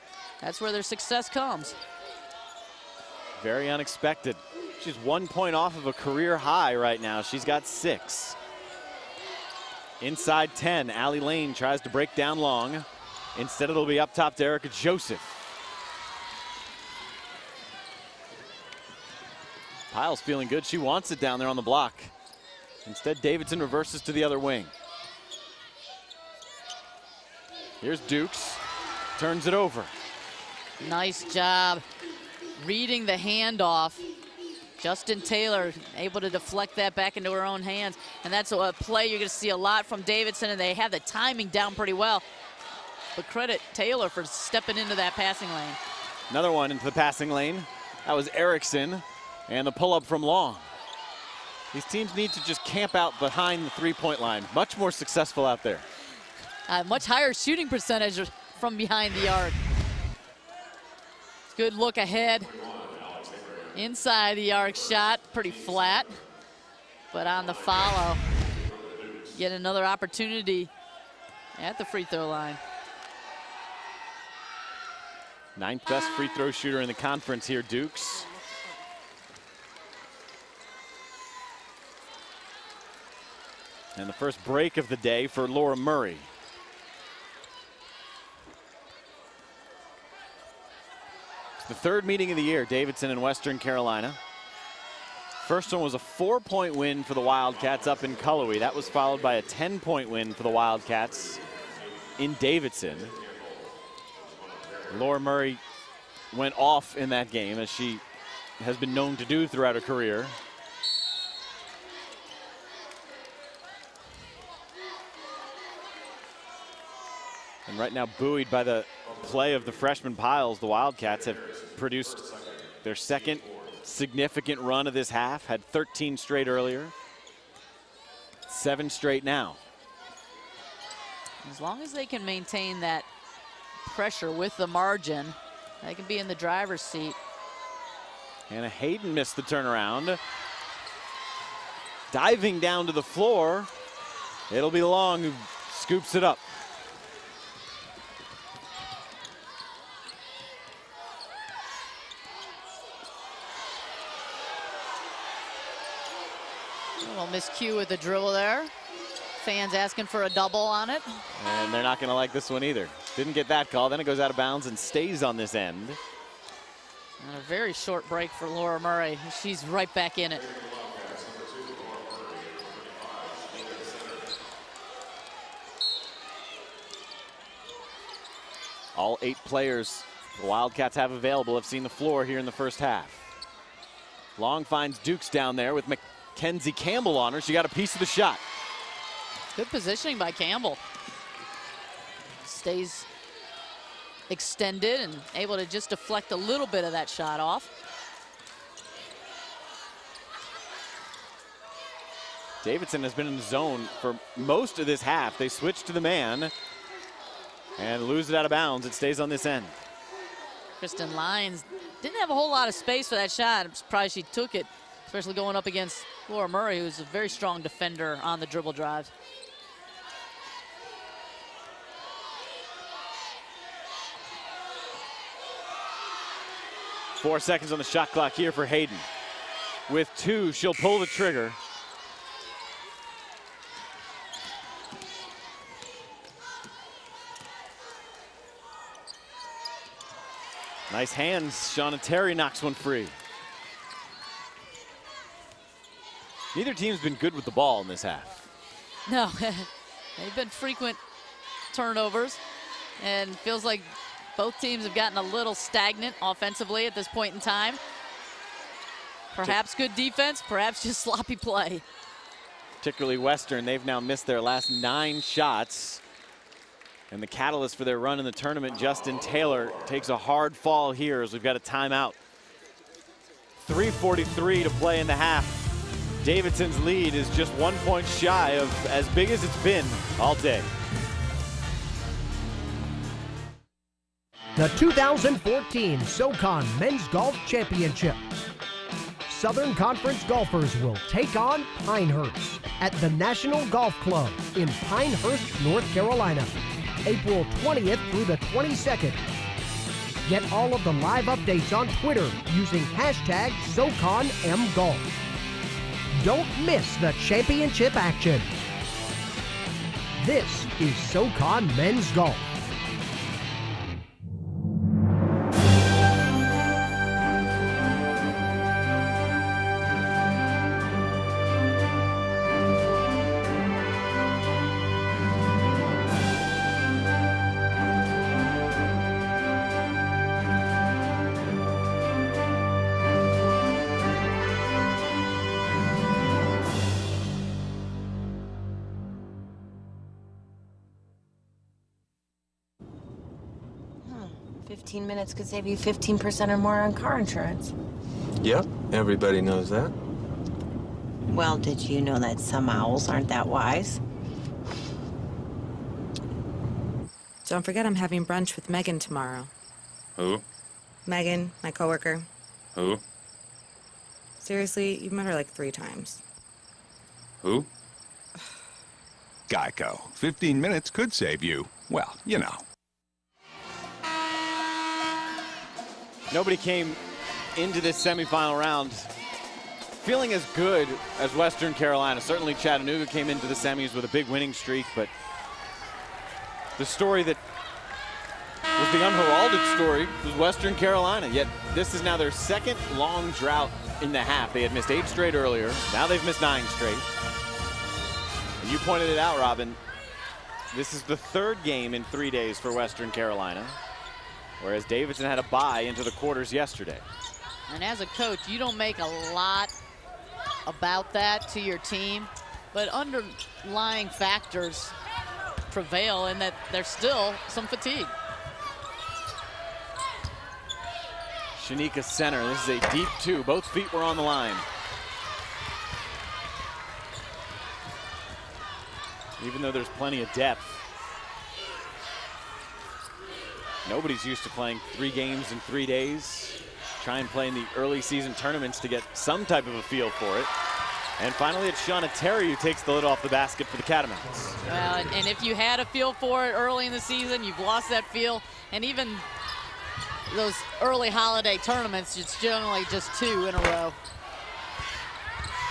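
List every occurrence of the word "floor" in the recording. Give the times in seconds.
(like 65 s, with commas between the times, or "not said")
143 s, 181 s.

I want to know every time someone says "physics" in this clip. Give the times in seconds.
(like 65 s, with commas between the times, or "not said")
not said.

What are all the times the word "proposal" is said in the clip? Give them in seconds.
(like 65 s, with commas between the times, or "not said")
not said.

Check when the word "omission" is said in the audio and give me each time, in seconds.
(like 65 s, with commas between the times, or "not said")
not said.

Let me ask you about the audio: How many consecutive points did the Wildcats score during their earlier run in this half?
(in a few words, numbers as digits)
13.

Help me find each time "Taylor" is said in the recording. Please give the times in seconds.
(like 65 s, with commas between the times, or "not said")
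35 s, 43 s, 269 s.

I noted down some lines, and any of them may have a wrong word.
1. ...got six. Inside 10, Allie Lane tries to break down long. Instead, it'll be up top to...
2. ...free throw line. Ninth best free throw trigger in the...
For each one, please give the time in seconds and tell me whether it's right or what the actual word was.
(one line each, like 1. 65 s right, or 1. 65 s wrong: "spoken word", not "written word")
1. 7 s right
2. 71 s wrong: "shooter", not "trigger".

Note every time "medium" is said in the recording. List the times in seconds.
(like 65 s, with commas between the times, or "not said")
not said.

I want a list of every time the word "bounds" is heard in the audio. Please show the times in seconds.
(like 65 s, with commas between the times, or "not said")
164 s, 208 s.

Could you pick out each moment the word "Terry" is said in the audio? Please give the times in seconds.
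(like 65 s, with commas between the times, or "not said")
242 s, 442 s.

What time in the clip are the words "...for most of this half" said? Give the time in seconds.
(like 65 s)
204 s.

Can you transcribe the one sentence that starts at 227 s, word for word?
Four seconds on the shot clock here for Hayden.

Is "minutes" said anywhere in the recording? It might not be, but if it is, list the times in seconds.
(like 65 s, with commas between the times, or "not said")
345 s, 370 s.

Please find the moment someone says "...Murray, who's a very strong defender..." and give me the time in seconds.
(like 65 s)
216 s.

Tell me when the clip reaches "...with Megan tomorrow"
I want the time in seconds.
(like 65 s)
358 s.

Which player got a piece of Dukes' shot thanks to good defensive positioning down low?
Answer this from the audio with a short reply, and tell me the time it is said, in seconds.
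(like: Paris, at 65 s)
Kenzie Campbell, at 186 s.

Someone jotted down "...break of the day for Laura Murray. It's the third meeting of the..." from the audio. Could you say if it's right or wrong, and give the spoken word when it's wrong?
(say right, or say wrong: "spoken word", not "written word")
right.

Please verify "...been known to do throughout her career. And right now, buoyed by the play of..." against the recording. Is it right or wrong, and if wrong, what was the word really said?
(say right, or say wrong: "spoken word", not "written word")
right.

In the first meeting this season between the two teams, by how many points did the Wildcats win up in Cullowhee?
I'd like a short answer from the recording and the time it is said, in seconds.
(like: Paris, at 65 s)
4, at 95 s.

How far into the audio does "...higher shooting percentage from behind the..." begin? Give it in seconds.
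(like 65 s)
57 s.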